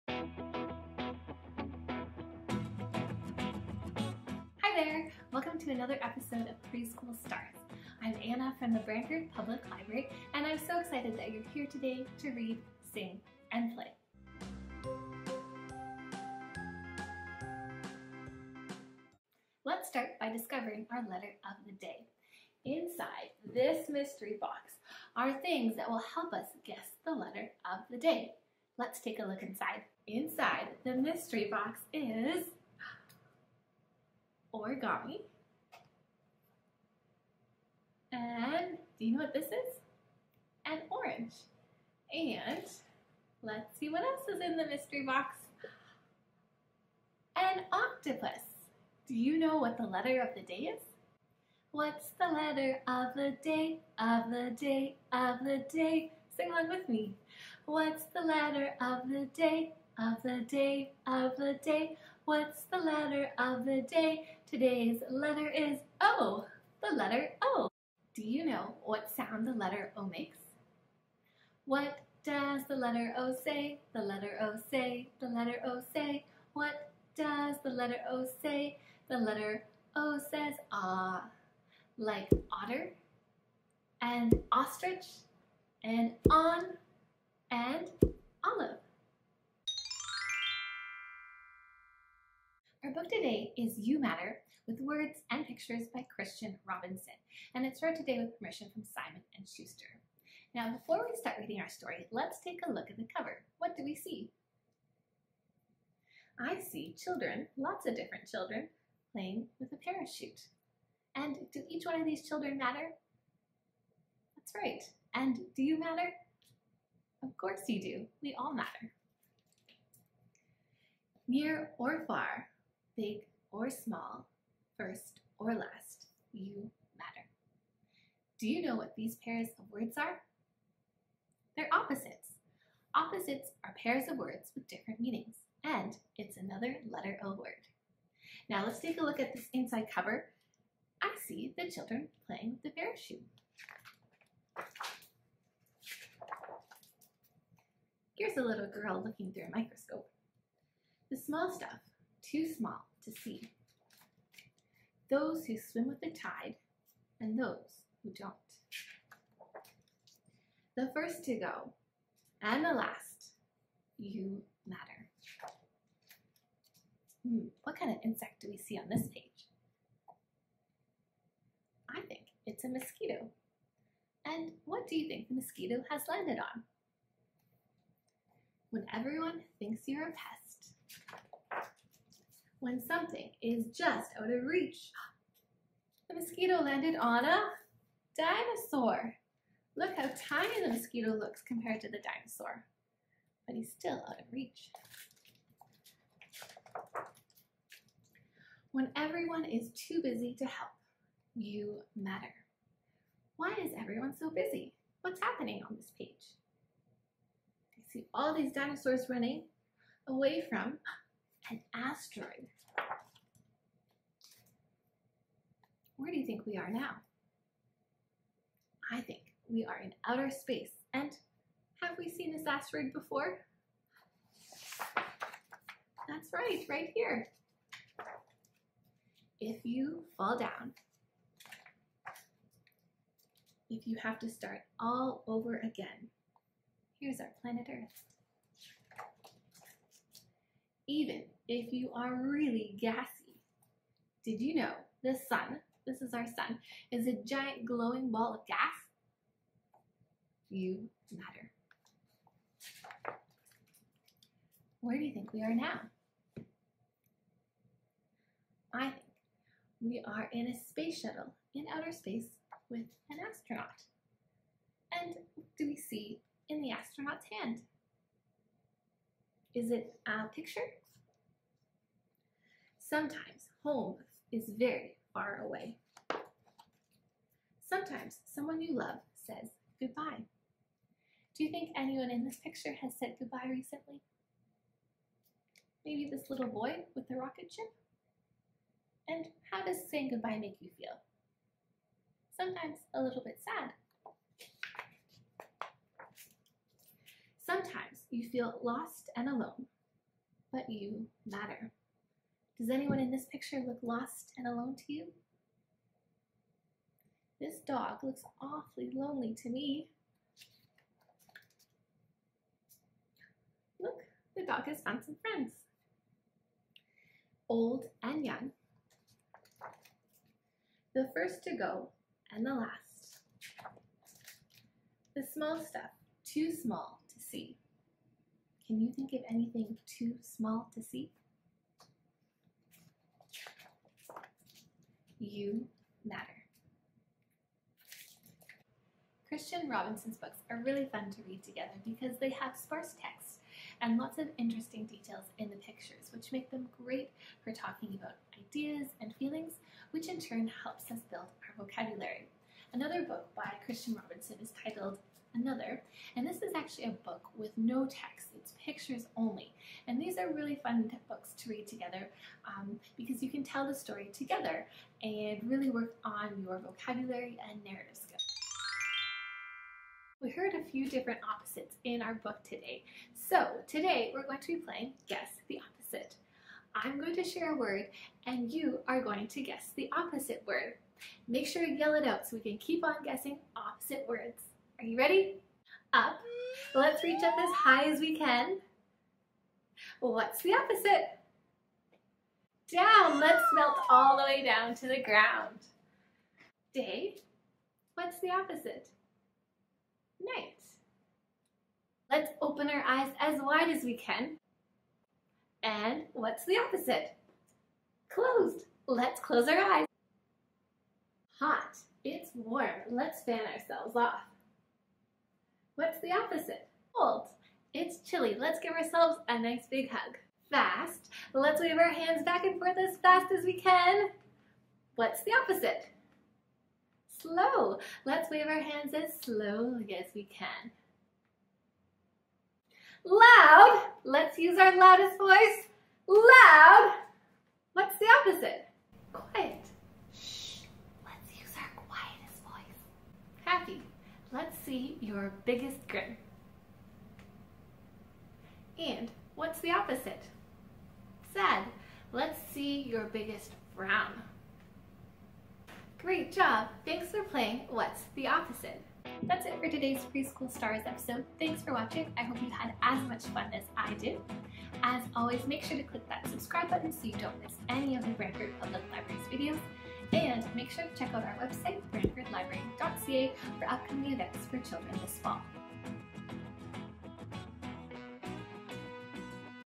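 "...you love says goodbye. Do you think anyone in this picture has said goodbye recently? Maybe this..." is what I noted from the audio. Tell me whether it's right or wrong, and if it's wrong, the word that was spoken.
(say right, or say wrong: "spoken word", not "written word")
right.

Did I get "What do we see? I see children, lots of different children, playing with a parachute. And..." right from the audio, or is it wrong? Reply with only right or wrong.
right.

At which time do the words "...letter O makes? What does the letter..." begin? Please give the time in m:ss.
1:09.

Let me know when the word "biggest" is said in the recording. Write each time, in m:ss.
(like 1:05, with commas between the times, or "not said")
7:25, 7:33.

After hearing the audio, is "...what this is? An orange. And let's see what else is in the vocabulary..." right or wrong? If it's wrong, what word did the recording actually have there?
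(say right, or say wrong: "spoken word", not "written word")
wrong: "mystery", not "vocabulary".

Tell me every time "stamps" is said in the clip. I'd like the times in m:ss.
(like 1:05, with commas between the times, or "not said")
not said.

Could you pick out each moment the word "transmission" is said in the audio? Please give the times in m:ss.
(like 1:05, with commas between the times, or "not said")
not said.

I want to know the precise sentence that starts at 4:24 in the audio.
And do we see in the astronaut's hand?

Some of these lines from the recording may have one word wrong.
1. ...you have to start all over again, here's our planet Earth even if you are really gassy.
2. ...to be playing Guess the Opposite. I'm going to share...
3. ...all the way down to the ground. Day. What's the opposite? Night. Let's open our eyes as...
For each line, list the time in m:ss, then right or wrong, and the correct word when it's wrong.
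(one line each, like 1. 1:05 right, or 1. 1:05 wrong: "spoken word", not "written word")
1. 3:53 right
2. 6:14 right
3. 6:33 right.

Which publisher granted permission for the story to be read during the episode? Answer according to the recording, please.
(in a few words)
Simon and Schuster.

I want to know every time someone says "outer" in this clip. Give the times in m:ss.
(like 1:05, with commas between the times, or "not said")
3:40, 4:21.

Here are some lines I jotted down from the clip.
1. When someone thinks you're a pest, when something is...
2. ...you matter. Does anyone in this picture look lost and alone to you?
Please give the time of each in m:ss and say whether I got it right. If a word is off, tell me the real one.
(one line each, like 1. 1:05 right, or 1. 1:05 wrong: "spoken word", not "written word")
1. 2:58 wrong: "everyone", not "someone"
2. 5:00 right.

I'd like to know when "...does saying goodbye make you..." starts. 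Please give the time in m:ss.
4:49.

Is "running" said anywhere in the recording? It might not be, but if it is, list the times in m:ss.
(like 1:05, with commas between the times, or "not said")
3:29.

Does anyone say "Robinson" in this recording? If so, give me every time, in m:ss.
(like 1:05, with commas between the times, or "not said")
1:36, 5:39, 5:54.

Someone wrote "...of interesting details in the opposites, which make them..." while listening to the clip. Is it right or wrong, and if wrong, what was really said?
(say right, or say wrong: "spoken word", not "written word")
wrong: "pictures", not "opposites".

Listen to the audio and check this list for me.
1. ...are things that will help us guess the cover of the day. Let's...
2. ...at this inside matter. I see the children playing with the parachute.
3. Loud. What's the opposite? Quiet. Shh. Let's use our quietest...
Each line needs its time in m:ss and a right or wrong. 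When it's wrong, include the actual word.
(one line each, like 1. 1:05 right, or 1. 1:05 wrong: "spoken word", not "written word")
1. 0:25 wrong: "letter", not "cover"
2. 2:19 wrong: "cover", not "matter"
3. 7:16 right.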